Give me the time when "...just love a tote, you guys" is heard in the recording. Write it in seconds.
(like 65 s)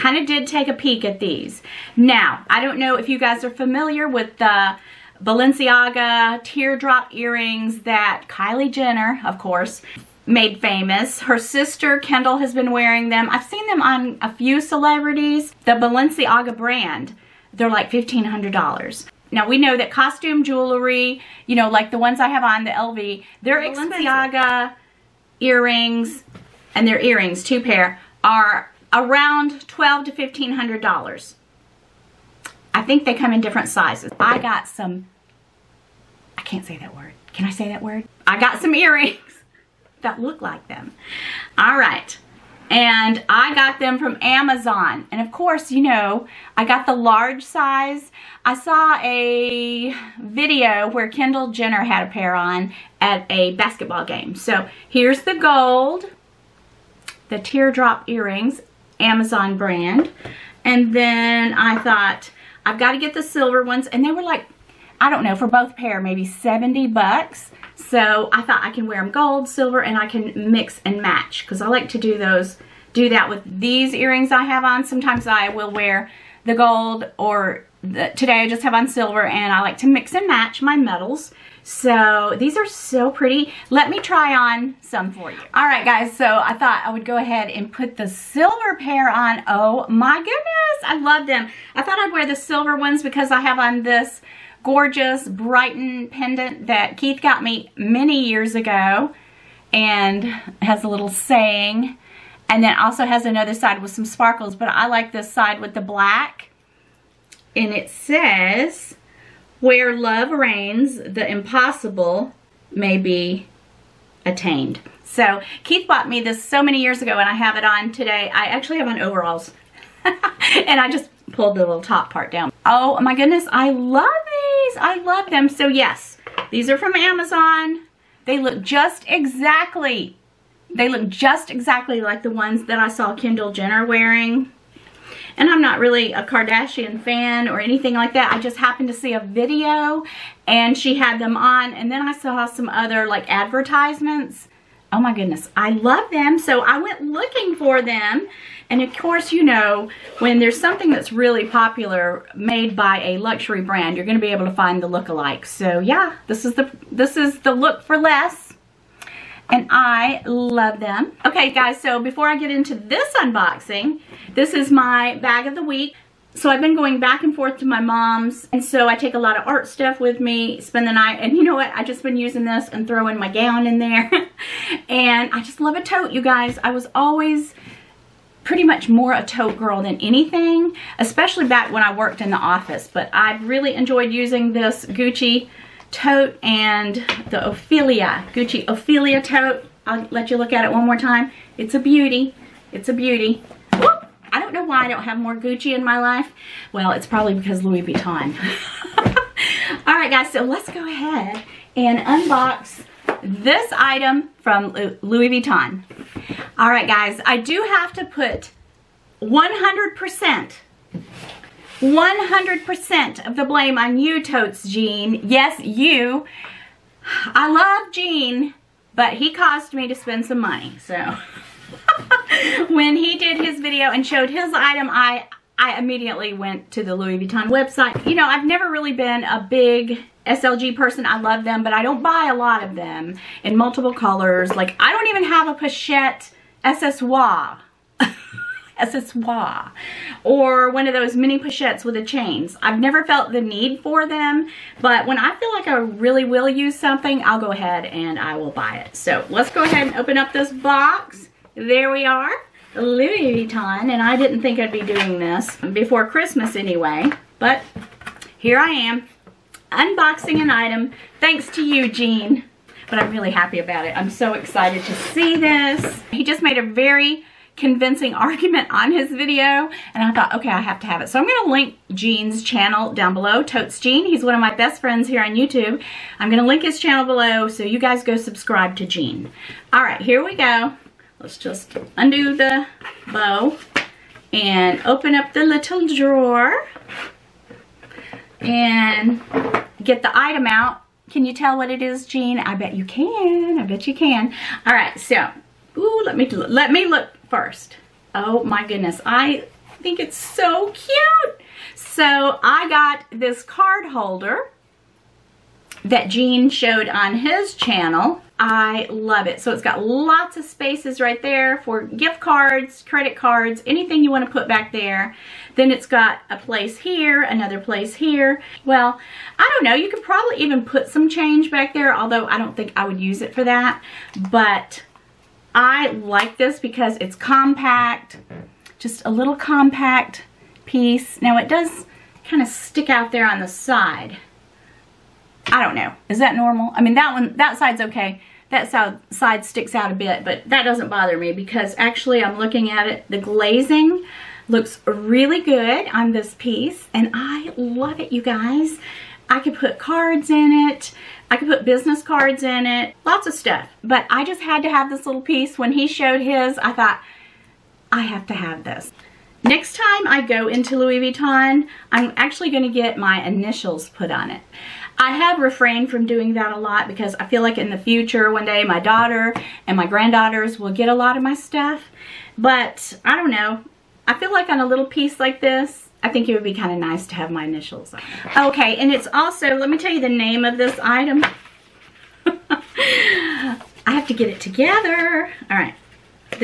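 175 s.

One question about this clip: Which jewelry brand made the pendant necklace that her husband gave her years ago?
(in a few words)
Brighton.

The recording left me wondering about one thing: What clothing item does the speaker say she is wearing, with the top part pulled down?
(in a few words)
Overalls.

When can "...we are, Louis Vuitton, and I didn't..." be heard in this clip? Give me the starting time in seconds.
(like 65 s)
251 s.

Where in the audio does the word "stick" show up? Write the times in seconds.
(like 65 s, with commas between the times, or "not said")
332 s, 339 s.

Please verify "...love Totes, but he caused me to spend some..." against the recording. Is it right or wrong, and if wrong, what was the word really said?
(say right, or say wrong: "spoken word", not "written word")
wrong: "Gene", not "Totes".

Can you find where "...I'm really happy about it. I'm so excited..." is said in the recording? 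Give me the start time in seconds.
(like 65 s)
262 s.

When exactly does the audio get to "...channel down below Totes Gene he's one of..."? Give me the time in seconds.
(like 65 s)
272 s.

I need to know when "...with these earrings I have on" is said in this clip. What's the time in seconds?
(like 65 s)
73 s.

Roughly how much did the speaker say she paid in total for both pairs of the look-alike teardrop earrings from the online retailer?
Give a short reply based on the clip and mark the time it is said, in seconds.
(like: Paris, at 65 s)
70 bucks, at 66 s.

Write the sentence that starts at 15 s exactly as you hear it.
The Balenciaga brand, they're like $1,500.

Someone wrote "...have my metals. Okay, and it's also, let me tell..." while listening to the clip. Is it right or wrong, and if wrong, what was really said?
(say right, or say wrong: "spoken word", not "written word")
wrong: "initials", not "metals".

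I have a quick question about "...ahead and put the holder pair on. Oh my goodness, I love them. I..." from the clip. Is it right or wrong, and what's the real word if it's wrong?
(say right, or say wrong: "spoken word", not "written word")
wrong: "silver", not "holder".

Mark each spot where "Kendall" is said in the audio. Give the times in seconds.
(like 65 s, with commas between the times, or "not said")
11 s, 51 s, 133 s.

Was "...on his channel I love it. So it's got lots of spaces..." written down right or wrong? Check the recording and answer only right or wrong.
right.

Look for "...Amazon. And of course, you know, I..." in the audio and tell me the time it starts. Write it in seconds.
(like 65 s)
44 s.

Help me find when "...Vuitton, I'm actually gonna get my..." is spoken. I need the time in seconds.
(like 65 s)
360 s.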